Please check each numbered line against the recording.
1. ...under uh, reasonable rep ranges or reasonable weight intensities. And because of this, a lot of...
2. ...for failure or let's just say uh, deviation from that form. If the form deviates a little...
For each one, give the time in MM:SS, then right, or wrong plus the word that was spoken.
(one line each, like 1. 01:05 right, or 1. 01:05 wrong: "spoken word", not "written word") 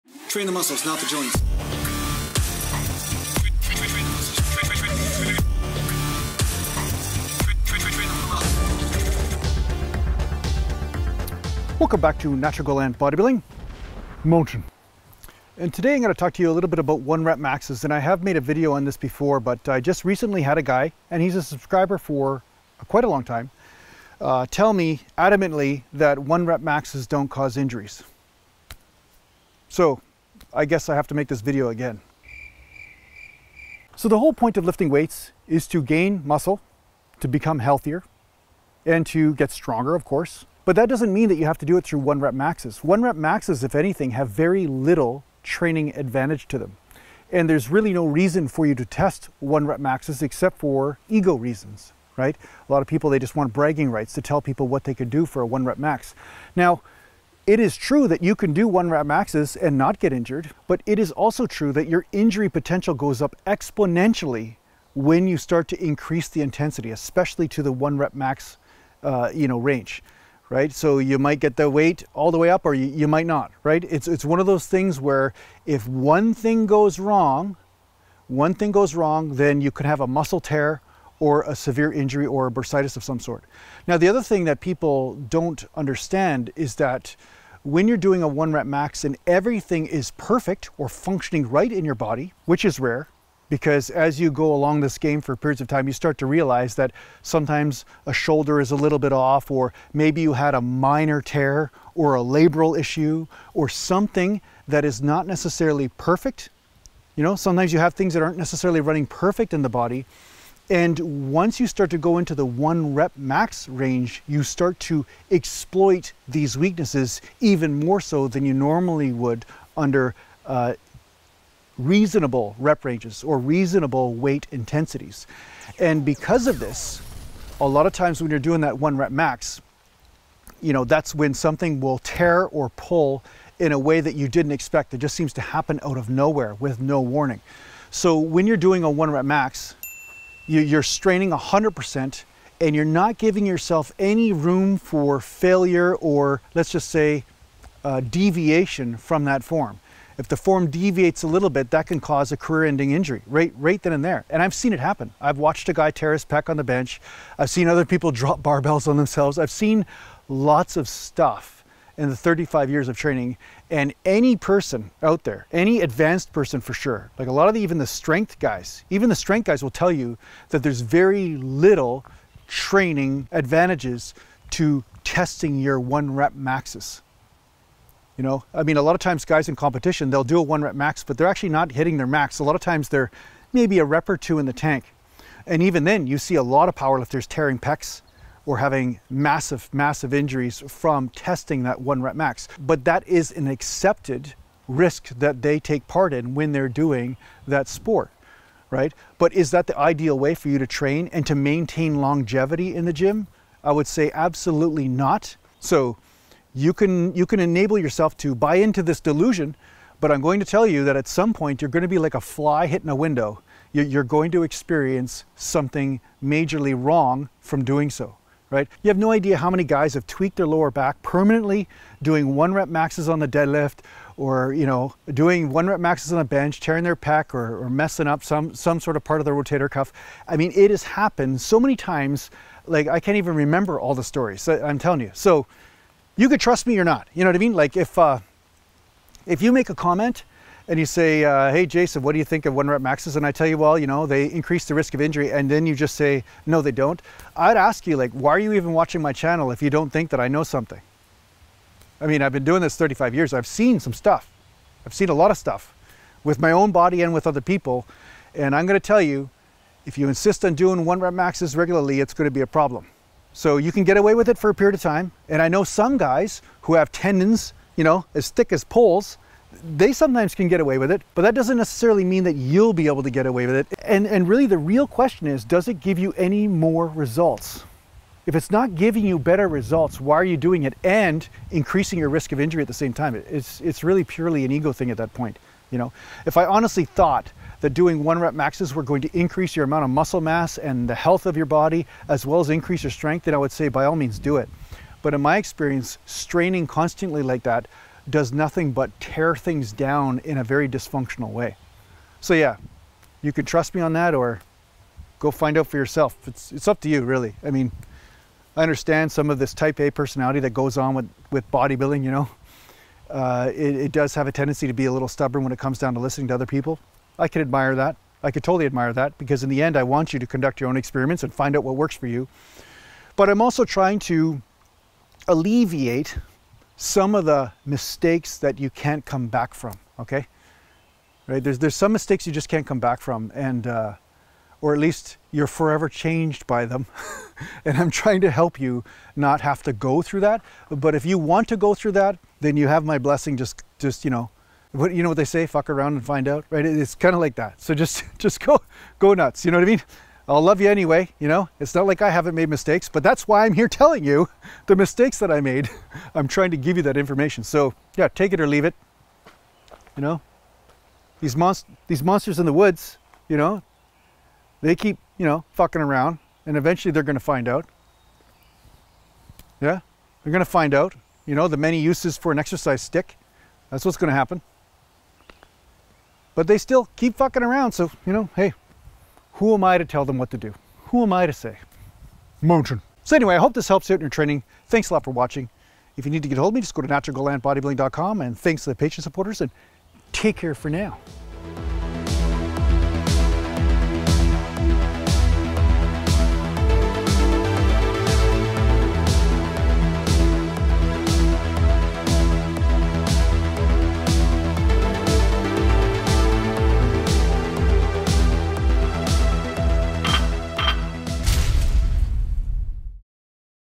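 1. 01:59 right
2. 02:24 right.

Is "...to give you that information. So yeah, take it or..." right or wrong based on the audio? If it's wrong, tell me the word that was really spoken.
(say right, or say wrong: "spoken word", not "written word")
right.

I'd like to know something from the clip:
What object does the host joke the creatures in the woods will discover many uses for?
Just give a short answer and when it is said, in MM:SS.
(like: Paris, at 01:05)
an exercise stick, at 06:12.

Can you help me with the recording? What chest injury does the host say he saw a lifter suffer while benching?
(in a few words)
tear his pec.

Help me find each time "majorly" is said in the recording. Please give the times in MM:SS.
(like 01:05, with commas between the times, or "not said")
03:36.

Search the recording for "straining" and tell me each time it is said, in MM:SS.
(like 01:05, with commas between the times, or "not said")
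02:20, 04:56.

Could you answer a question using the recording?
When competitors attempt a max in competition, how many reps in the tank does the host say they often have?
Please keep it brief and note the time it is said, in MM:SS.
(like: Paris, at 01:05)
a rep or two, at 03:03.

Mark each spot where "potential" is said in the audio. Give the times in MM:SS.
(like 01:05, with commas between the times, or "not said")
01:02.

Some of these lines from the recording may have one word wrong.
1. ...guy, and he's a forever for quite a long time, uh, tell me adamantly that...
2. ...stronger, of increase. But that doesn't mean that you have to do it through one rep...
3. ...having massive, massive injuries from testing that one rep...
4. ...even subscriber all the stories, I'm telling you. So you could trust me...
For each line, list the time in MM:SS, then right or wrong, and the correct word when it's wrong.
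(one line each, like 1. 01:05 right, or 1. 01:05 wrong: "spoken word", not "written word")
1. 00:20 wrong: "subscriber", not "forever"
2. 00:39 wrong: "course", not "increase"
3. 03:08 right
4. 03:53 wrong: "remember", not "subscriber".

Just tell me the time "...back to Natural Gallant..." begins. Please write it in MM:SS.
00:11.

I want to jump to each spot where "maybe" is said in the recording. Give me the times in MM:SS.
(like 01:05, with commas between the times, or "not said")
01:39, 03:03.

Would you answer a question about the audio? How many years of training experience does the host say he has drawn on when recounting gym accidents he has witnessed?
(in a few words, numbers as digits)
35.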